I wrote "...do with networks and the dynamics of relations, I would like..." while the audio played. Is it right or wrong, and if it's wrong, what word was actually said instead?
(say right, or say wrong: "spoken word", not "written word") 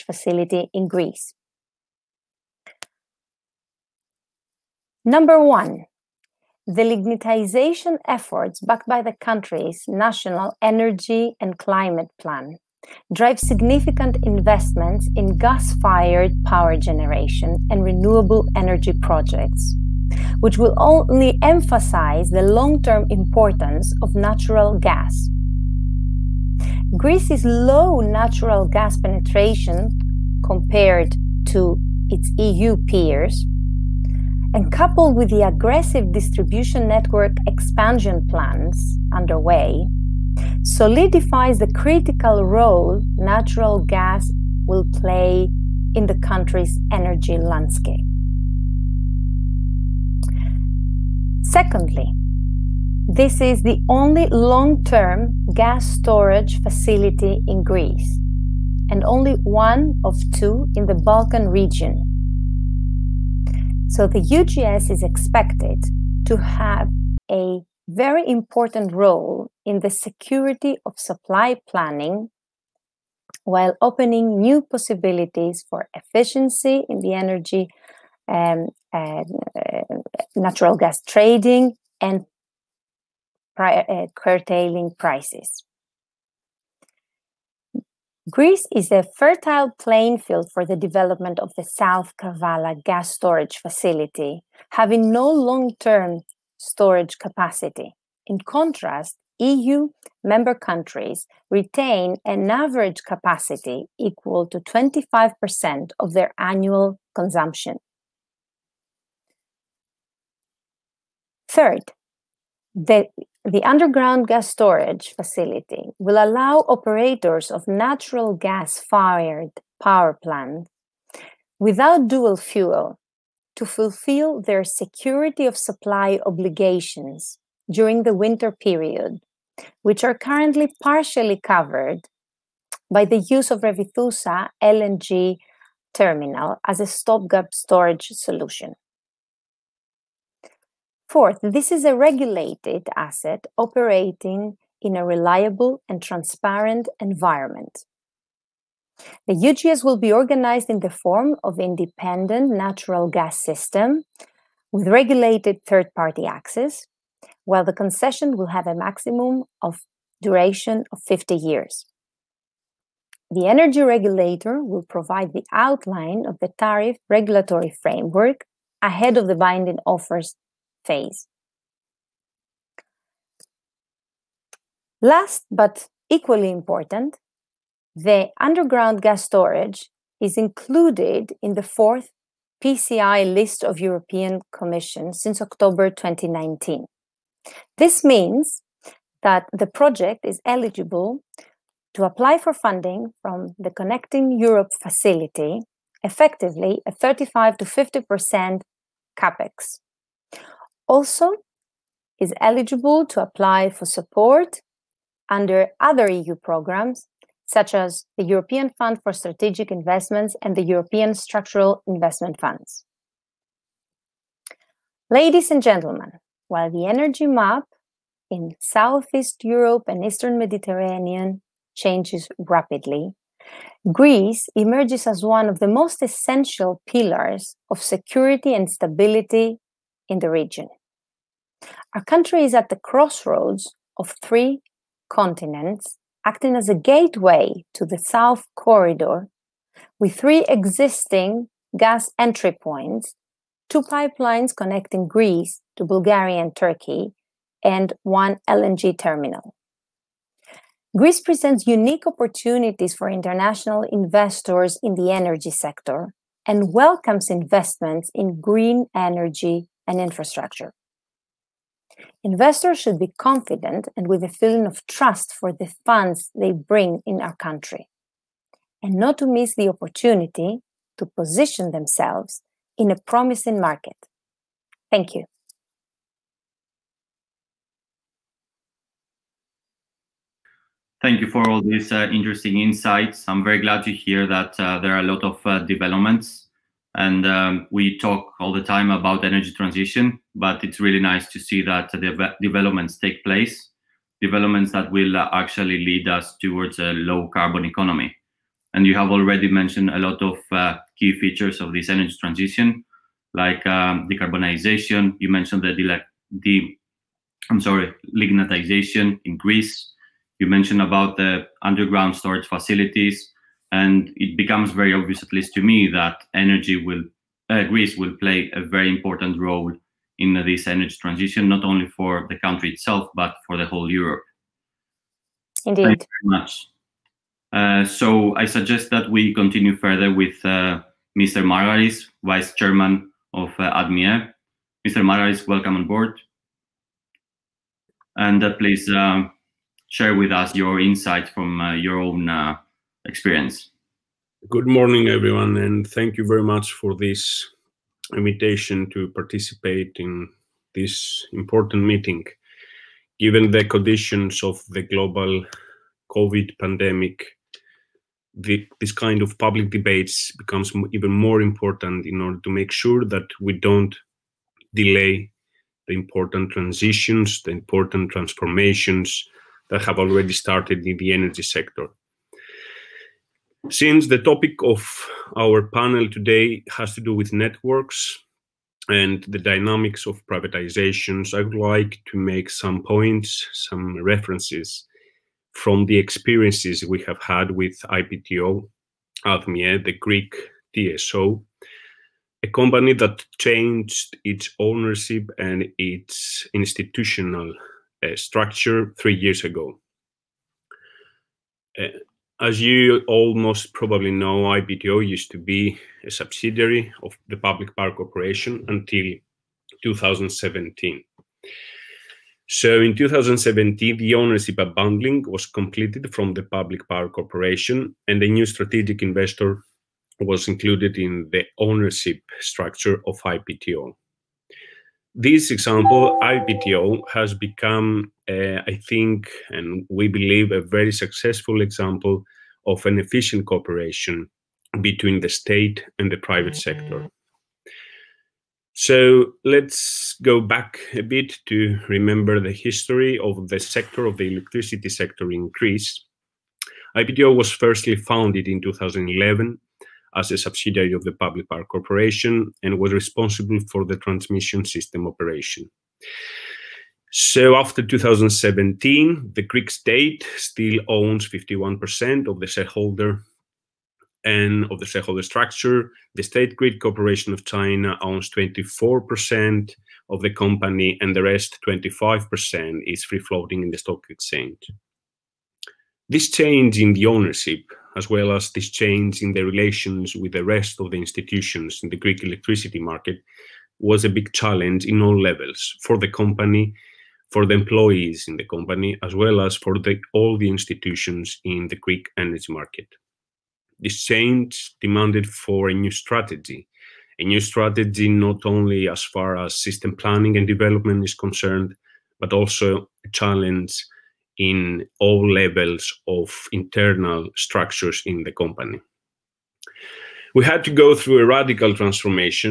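wrong: "privatizations", not "relations".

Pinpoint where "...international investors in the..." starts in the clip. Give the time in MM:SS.
04:13.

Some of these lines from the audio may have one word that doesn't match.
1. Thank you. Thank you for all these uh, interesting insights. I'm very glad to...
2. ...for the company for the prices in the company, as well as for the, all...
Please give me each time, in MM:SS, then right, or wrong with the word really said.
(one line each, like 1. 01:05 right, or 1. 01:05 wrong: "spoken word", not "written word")
1. 04:34 right
2. 08:05 wrong: "employees", not "prices".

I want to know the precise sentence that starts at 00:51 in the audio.
Secondly, this is the only long term gas storage facility in Greece and only one of two in the Balkan region.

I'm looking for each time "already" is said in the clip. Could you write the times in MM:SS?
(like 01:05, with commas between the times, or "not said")
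04:59, 06:09.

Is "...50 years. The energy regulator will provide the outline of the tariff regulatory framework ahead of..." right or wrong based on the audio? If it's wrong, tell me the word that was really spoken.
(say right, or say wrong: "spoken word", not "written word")
right.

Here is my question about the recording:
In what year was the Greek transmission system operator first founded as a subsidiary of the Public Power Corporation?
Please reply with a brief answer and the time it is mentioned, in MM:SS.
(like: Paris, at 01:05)
2011, at 07:28.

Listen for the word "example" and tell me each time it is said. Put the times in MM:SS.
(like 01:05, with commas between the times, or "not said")
07:05, 07:11.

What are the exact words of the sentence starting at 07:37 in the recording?
So after 2017, the Greek state still owns 51% of the shareholder and of the shareholder structure.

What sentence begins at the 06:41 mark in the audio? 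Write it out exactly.
Uh, as you almost probably know, IPTO used to be a subsidiary of the Public Power Corporation until 2017.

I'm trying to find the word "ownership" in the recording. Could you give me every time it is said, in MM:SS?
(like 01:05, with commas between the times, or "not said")
06:34, 06:54, 07:01, 07:57.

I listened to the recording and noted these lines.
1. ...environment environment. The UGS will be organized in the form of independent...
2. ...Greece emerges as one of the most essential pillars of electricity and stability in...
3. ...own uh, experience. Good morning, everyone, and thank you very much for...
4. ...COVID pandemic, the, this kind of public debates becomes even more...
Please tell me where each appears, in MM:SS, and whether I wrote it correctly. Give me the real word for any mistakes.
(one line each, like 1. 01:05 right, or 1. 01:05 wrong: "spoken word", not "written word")
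1. 02:26 wrong: "transparent", not "environment"
2. 03:43 wrong: "security", not "electricity"
3. 05:41 right
4. 05:56 right.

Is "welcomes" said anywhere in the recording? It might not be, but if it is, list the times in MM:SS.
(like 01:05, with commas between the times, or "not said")
04:16, 05:35.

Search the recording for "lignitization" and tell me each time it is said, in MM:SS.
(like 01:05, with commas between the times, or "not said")
00:06, 05:08.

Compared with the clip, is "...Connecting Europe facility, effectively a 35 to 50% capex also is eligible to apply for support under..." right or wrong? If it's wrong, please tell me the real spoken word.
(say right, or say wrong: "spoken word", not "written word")
right.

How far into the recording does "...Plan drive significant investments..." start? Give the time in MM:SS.
00:12.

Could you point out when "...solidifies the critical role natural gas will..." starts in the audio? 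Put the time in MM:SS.
00:40.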